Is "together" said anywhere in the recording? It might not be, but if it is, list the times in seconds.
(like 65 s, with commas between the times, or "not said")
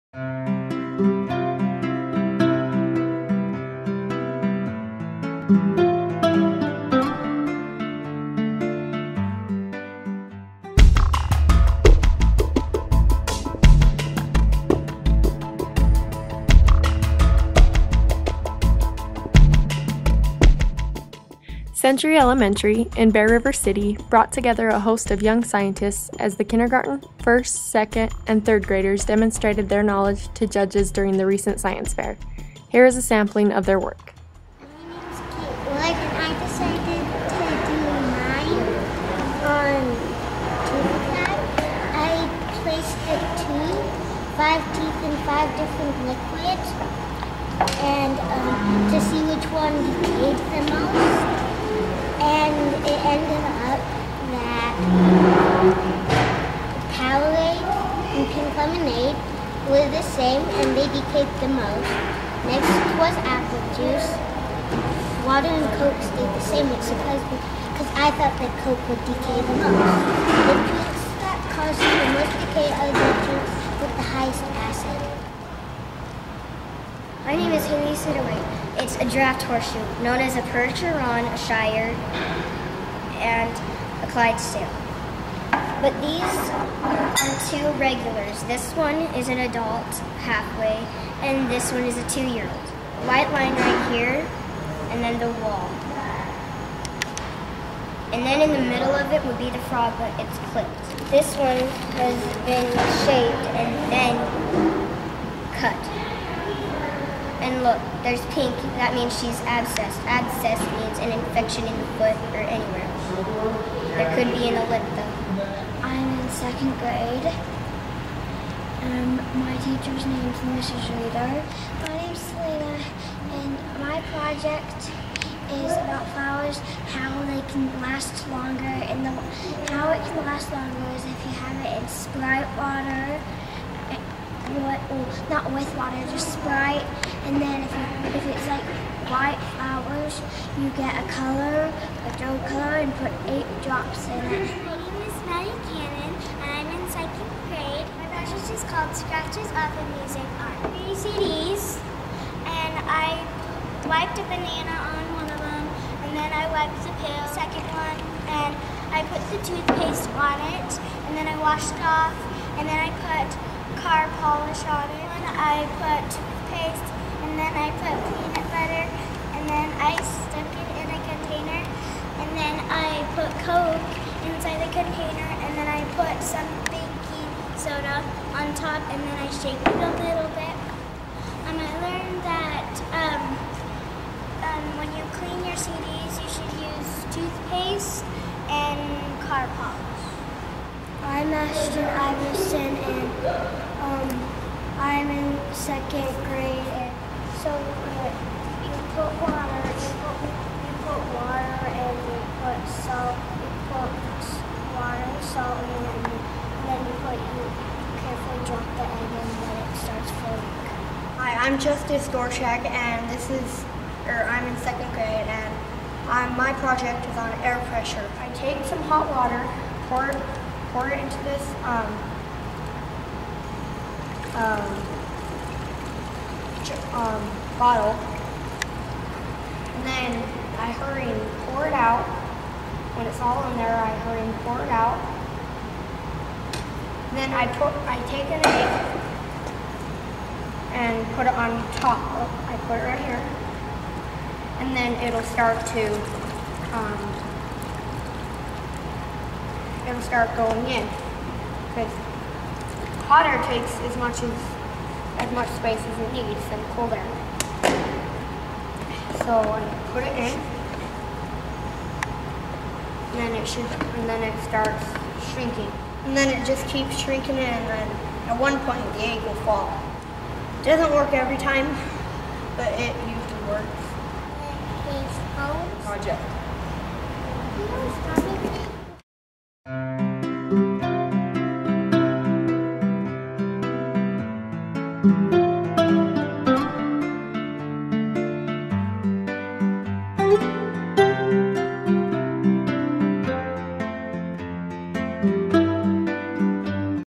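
24 s.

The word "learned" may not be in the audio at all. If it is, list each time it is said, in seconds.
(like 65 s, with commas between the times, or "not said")
181 s.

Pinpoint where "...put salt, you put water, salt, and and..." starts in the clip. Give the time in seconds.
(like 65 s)
202 s.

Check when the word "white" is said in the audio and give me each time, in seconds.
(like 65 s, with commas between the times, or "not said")
93 s, 139 s.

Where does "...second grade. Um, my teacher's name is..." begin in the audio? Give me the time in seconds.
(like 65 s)
116 s.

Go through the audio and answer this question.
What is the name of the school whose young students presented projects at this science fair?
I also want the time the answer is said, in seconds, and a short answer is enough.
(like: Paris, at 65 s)
Century Elementary, at 21 s.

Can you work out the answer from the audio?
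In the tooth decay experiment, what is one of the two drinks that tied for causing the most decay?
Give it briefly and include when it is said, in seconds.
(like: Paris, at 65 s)
Powerade, at 56 s.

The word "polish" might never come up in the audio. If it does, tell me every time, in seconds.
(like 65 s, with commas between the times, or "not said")
164 s, 189 s.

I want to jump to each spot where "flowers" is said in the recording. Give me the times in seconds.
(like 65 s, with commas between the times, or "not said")
126 s, 139 s.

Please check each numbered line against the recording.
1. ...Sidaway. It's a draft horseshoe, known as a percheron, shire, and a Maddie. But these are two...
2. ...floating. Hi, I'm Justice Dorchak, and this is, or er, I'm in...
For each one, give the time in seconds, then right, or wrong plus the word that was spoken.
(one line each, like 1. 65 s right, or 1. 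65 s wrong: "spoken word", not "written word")
1. 77 s wrong: "Clydesdale", not "Maddie"
2. 210 s right.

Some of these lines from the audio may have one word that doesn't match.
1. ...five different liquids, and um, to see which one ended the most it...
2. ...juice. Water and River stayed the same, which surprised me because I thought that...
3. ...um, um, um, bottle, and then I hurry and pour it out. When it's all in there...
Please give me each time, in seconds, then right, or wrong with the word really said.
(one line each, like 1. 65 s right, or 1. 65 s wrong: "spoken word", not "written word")
1. 45 s wrong: "decayed", not "ended"
2. 63 s wrong: "Coke", not "River"
3. 221 s right.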